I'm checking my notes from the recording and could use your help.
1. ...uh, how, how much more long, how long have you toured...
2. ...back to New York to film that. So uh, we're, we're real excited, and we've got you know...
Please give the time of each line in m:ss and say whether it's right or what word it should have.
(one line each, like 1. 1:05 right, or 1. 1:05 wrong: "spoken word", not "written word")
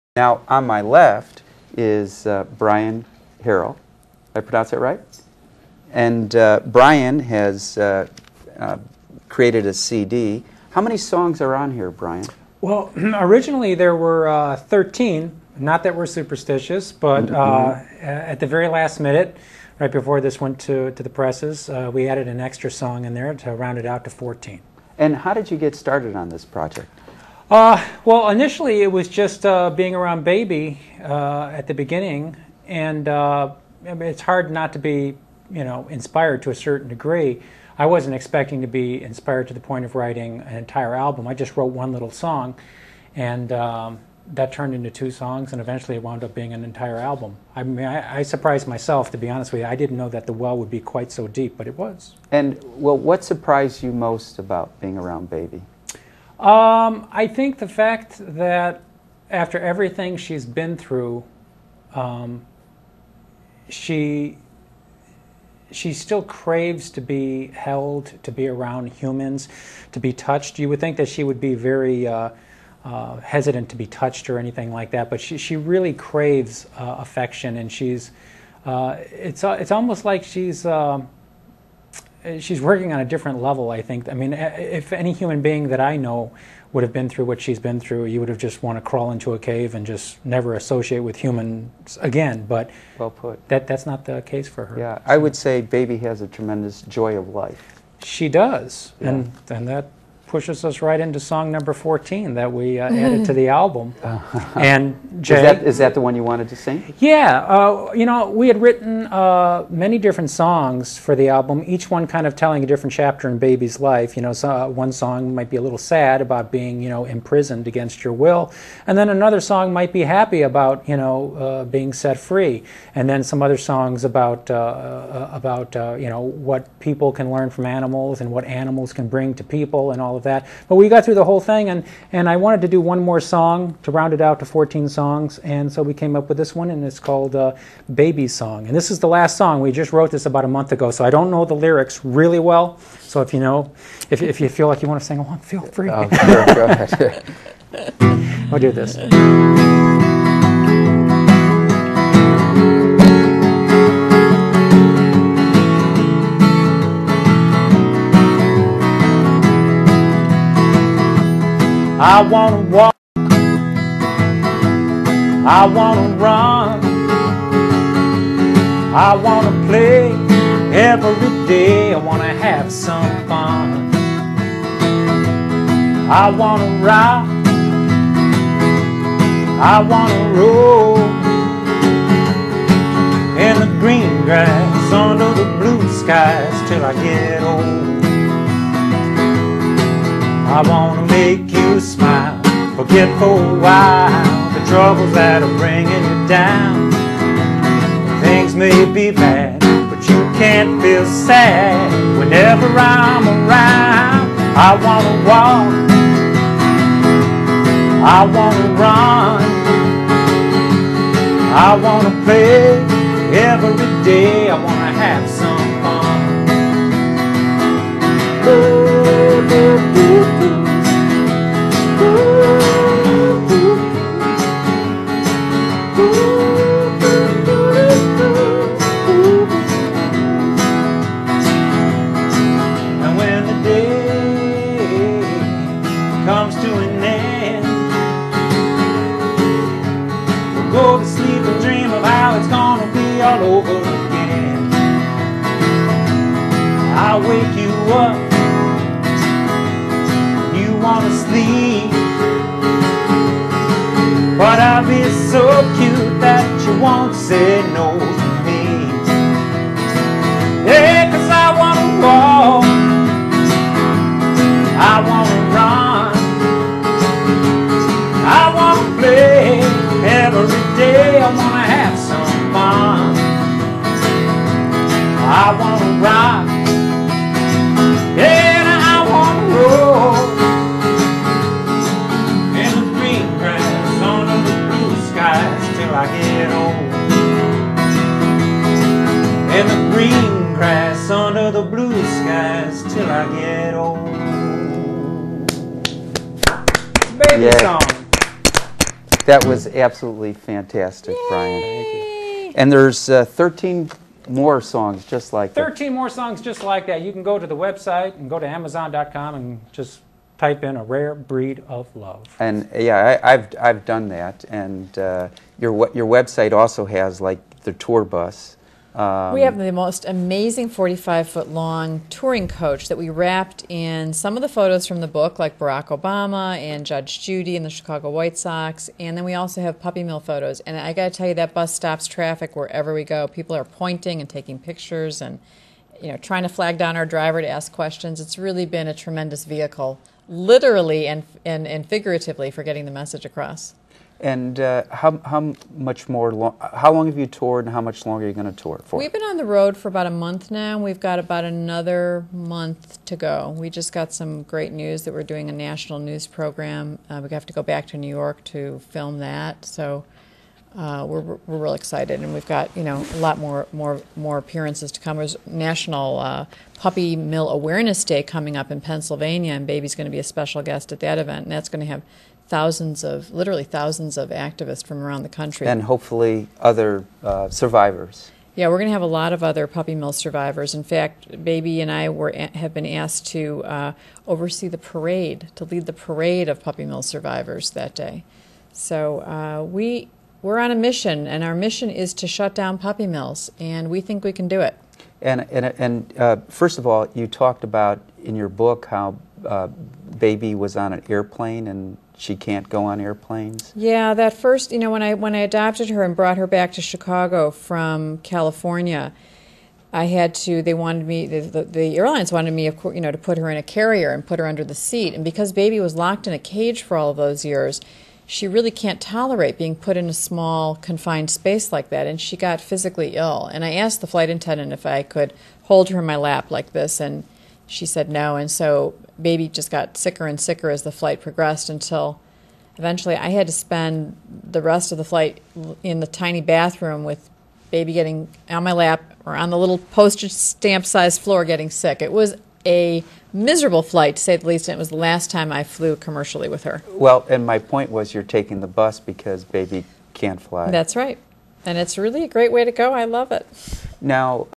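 1. 5:44 right
2. 5:57 right.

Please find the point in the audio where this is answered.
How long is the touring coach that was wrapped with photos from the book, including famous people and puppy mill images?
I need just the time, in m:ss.
5:20.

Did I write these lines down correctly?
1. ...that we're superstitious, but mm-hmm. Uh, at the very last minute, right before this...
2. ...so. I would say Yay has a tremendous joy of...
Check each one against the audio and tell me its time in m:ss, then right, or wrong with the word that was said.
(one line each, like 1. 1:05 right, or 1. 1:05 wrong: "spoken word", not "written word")
1. 0:15 right
2. 1:34 wrong: "Baby", not "Yay".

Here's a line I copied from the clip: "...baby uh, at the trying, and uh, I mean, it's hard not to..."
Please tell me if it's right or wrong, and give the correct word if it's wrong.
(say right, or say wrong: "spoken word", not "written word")
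wrong: "beginning", not "trying".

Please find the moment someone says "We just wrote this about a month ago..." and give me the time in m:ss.
2:19.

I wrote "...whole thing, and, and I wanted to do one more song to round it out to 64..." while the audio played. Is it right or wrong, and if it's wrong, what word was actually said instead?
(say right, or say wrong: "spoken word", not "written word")
wrong: "14", not "64".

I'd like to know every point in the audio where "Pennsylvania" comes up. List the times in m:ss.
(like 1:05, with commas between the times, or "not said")
6:08.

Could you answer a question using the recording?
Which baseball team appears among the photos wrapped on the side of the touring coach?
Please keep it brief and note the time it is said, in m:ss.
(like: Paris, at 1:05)
Chicago White Sox, at 5:27.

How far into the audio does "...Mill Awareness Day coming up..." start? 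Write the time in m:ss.
6:07.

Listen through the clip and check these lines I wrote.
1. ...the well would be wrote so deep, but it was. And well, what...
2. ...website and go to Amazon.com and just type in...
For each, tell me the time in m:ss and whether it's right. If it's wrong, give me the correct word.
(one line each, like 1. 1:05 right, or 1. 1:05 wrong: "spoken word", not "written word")
1. 0:50 wrong: "quite", not "wrote"
2. 5:07 right.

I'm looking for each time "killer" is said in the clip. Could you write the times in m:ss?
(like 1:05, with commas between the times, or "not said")
not said.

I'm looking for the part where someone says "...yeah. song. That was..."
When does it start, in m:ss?
4:57.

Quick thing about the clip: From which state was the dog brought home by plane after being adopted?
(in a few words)
California.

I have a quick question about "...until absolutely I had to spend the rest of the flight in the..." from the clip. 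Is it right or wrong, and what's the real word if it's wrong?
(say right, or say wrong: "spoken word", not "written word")
wrong: "eventually", not "absolutely".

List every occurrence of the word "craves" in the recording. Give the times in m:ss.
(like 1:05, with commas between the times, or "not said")
1:06, 1:15.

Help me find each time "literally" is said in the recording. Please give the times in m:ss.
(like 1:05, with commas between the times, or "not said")
5:40, 6:13.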